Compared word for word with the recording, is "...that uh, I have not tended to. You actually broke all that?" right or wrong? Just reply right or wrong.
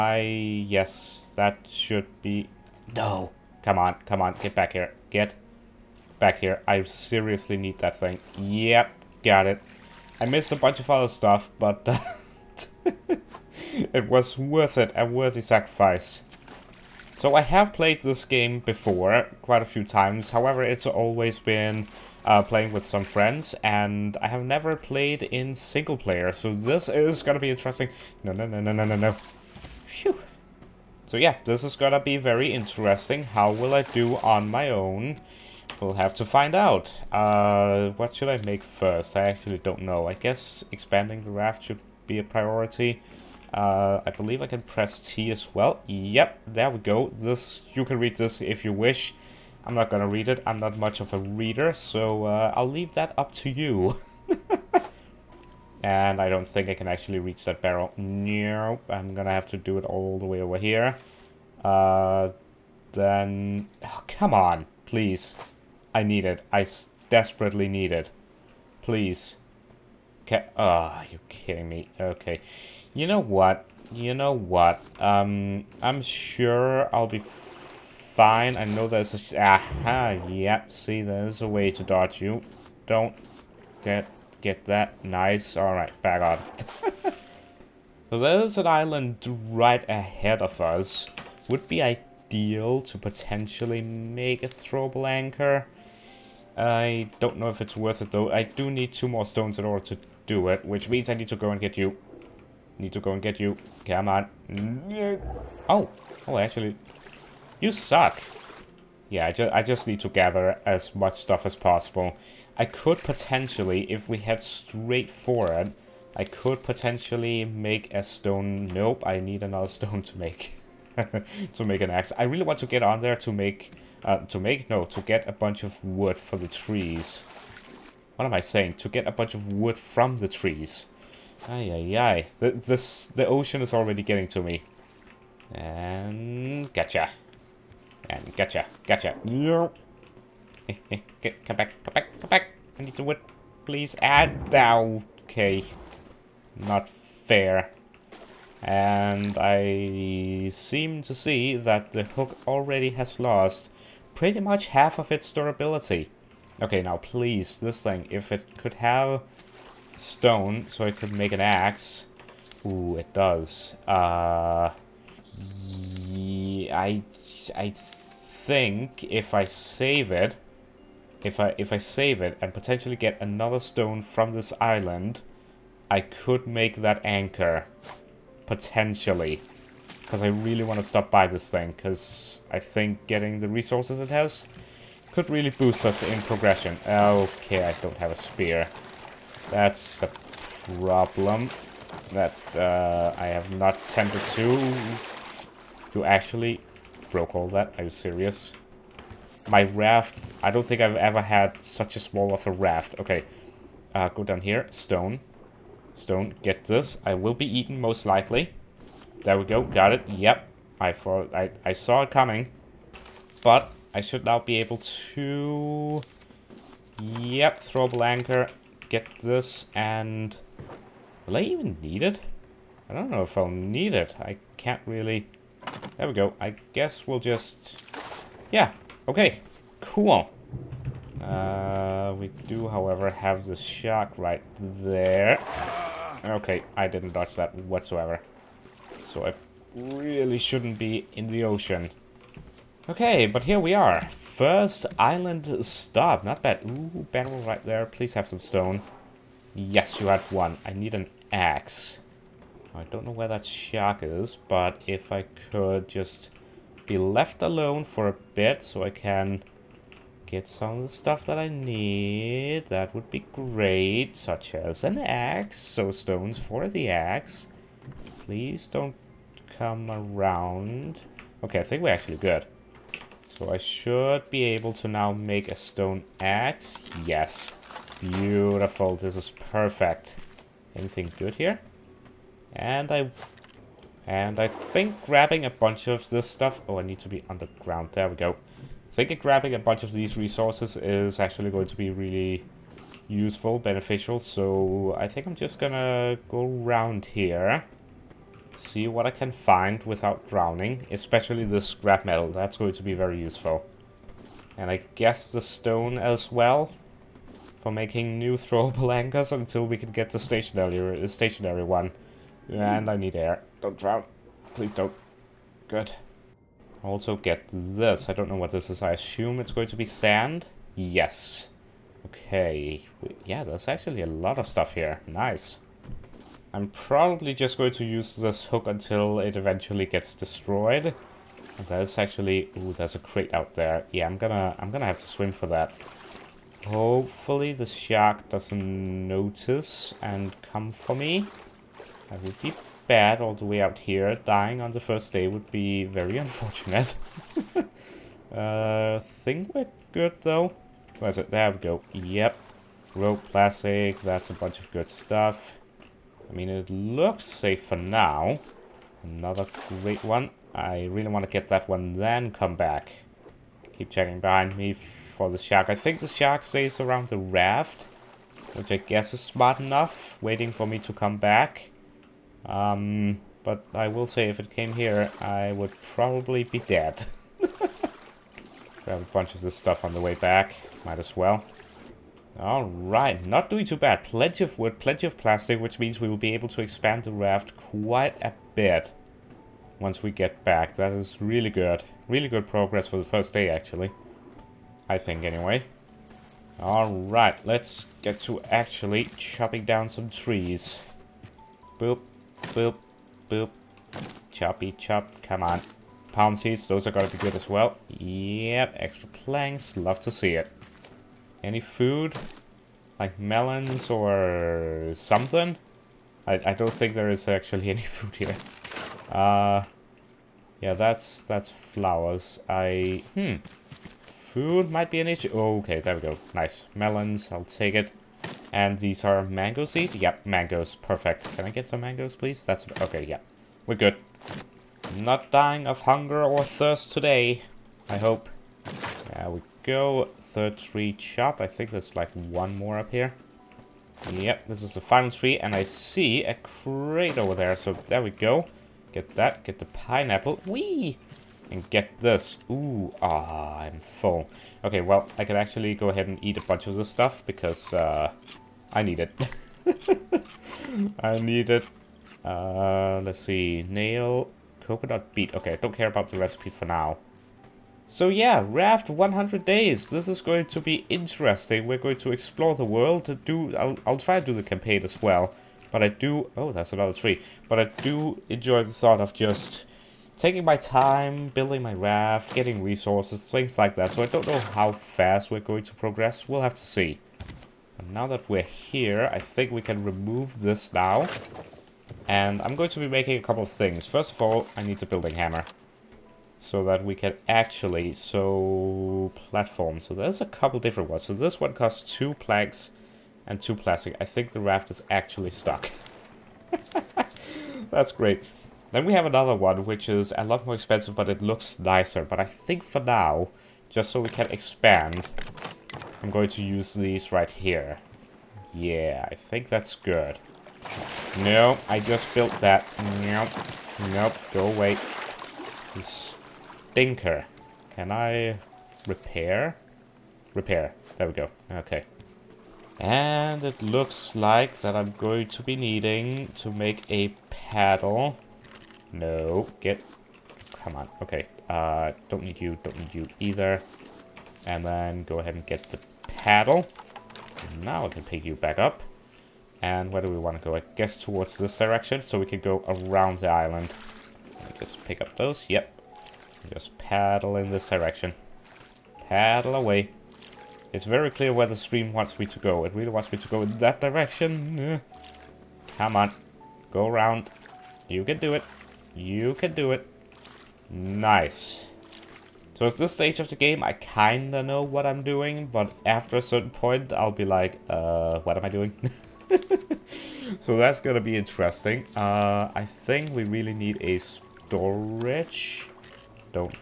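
right.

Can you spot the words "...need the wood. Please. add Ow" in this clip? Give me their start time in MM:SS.
02:22.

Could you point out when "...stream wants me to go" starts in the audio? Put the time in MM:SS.
09:21.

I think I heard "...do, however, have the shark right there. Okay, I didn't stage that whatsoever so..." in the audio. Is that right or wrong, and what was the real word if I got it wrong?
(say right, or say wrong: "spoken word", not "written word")
wrong: "dodge", not "stage".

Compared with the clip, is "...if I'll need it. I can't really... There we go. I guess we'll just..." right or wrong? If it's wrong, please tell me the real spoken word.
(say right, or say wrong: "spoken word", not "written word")
right.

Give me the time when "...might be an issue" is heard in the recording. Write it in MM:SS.
07:04.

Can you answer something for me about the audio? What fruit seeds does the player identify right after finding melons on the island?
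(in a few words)
Mango seeds.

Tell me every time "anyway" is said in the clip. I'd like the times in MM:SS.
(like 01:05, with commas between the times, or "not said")
06:35.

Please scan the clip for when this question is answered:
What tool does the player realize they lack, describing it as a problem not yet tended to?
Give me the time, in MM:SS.
03:08.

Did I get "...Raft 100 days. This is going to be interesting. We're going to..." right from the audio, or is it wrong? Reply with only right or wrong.
right.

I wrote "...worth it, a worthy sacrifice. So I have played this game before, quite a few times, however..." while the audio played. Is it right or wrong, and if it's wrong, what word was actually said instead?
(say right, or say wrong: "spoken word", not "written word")
right.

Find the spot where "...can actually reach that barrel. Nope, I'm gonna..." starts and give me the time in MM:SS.
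00:56.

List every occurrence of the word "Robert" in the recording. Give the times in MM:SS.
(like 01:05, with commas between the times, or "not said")
not said.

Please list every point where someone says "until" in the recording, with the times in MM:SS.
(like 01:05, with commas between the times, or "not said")
05:09, 05:28.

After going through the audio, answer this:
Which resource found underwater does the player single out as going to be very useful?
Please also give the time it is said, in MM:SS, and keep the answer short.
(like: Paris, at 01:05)
Scrap metal, at 05:01.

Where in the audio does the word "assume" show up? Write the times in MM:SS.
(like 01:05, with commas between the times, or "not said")
05:18.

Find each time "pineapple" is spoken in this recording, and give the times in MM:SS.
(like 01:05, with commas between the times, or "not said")
07:29.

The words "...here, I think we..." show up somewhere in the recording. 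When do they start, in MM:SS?
08:08.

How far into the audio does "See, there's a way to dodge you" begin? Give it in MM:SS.
01:20.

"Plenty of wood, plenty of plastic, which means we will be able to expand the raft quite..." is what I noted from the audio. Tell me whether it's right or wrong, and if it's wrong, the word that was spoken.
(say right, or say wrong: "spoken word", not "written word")
right.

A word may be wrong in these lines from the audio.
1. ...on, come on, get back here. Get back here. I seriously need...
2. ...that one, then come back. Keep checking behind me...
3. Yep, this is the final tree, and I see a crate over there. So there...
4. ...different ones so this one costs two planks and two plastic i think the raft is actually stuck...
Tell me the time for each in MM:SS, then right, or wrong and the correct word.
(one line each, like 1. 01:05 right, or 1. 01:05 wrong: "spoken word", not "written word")
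1. 00:03 right
2. 06:01 right
3. 07:24 right
4. 08:20 right.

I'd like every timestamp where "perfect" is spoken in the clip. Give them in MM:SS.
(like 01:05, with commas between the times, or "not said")
04:39, 07:10.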